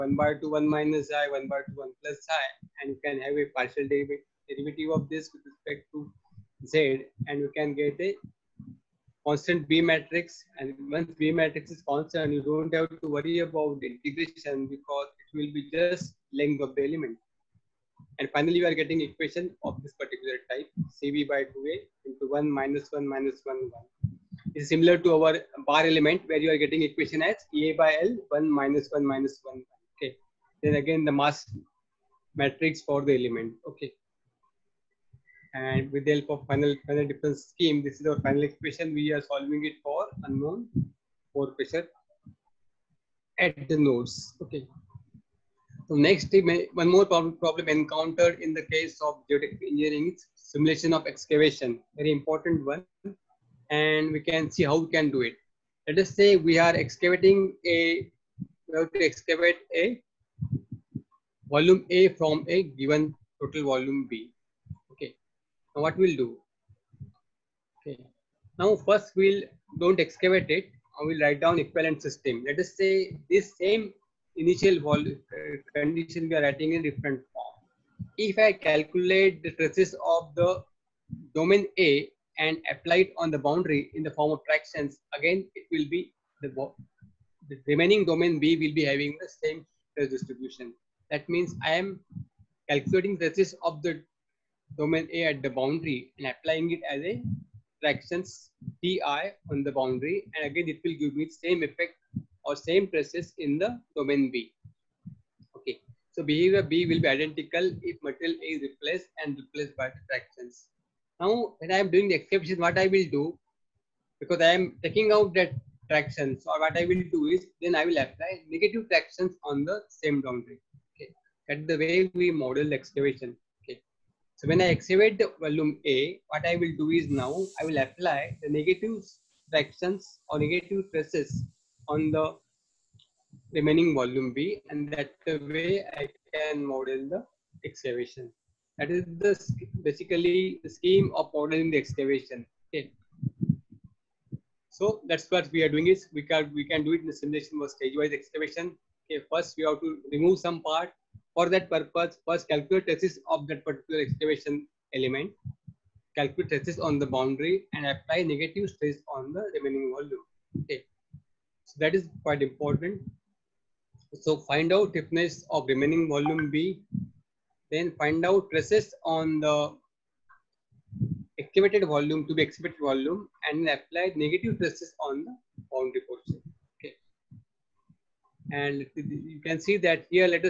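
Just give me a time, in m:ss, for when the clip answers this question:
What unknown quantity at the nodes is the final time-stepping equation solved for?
0:41.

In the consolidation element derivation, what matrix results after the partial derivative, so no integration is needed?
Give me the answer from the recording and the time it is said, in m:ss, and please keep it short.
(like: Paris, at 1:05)
constant B matrix, at 0:09.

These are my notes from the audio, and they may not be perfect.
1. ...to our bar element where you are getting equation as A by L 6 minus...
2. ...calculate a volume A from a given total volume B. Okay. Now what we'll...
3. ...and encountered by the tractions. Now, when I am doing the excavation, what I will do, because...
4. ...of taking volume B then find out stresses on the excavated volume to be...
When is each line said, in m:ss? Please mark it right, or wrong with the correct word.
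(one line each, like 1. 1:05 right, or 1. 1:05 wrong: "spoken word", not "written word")
1. 0:24 wrong: "1", not "6"
2. 0:59 wrong: "excavate", not "calculate"
3. 1:49 wrong: "replaced", not "encountered"
4. 2:45 wrong: "remaining", not "taking".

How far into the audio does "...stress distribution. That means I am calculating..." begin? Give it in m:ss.
1:29.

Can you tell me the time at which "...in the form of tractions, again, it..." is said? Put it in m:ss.
1:23.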